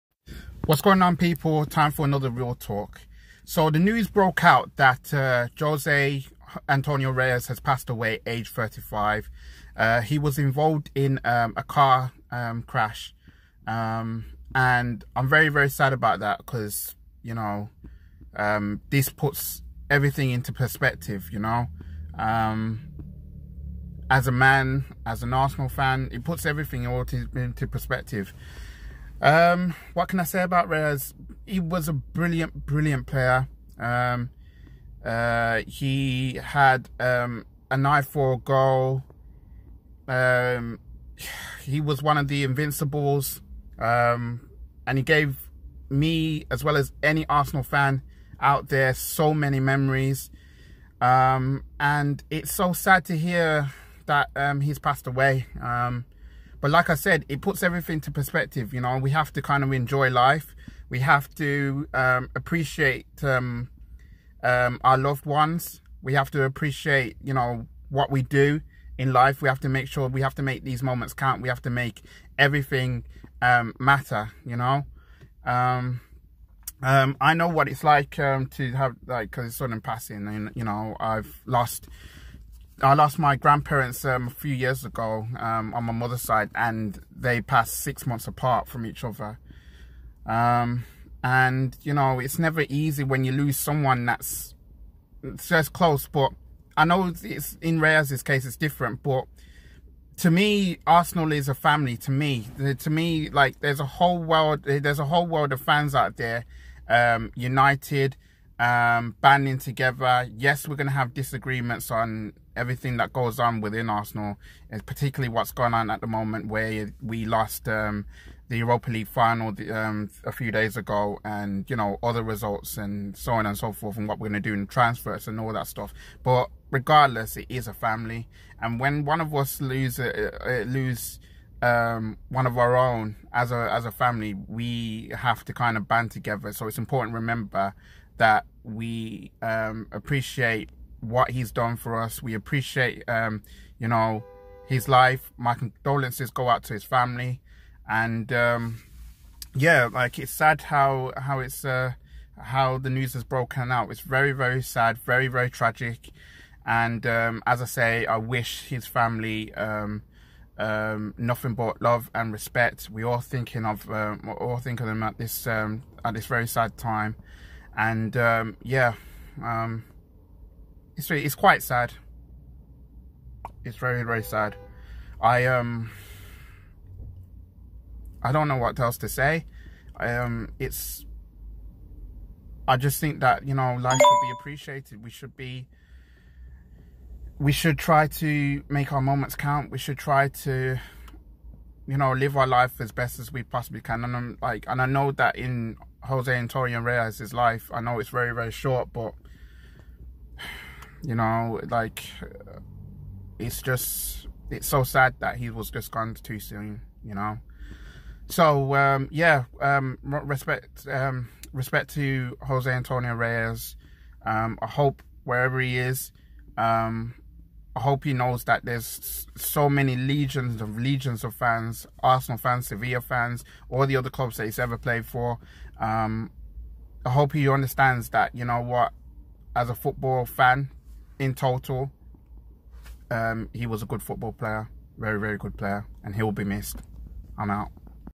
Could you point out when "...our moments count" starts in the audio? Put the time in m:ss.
3:08.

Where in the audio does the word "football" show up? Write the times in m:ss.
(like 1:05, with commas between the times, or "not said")
3:49, 3:54.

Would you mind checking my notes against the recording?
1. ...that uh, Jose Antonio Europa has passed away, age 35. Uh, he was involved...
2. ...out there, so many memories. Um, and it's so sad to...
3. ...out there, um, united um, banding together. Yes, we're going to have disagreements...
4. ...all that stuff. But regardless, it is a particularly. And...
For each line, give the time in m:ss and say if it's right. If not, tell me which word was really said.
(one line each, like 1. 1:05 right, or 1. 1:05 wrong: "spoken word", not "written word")
1. 0:04 wrong: "Reyes", not "Europa"
2. 0:48 right
3. 1:45 right
4. 2:05 wrong: "family", not "particularly".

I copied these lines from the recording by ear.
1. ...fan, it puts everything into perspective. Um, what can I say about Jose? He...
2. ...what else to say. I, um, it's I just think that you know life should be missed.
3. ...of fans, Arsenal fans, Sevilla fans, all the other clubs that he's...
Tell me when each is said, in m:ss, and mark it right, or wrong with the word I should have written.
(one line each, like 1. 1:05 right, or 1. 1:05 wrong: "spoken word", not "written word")
1. 0:25 wrong: "Reyes", not "Jose"
2. 2:58 wrong: "appreciated", not "missed"
3. 3:41 right.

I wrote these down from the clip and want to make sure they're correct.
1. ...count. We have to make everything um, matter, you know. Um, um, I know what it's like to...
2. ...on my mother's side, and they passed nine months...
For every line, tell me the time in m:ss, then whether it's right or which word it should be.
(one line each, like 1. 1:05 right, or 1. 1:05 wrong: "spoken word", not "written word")
1. 1:11 right
2. 1:25 wrong: "six", not "nine".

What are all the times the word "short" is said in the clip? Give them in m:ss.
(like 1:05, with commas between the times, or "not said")
3:18.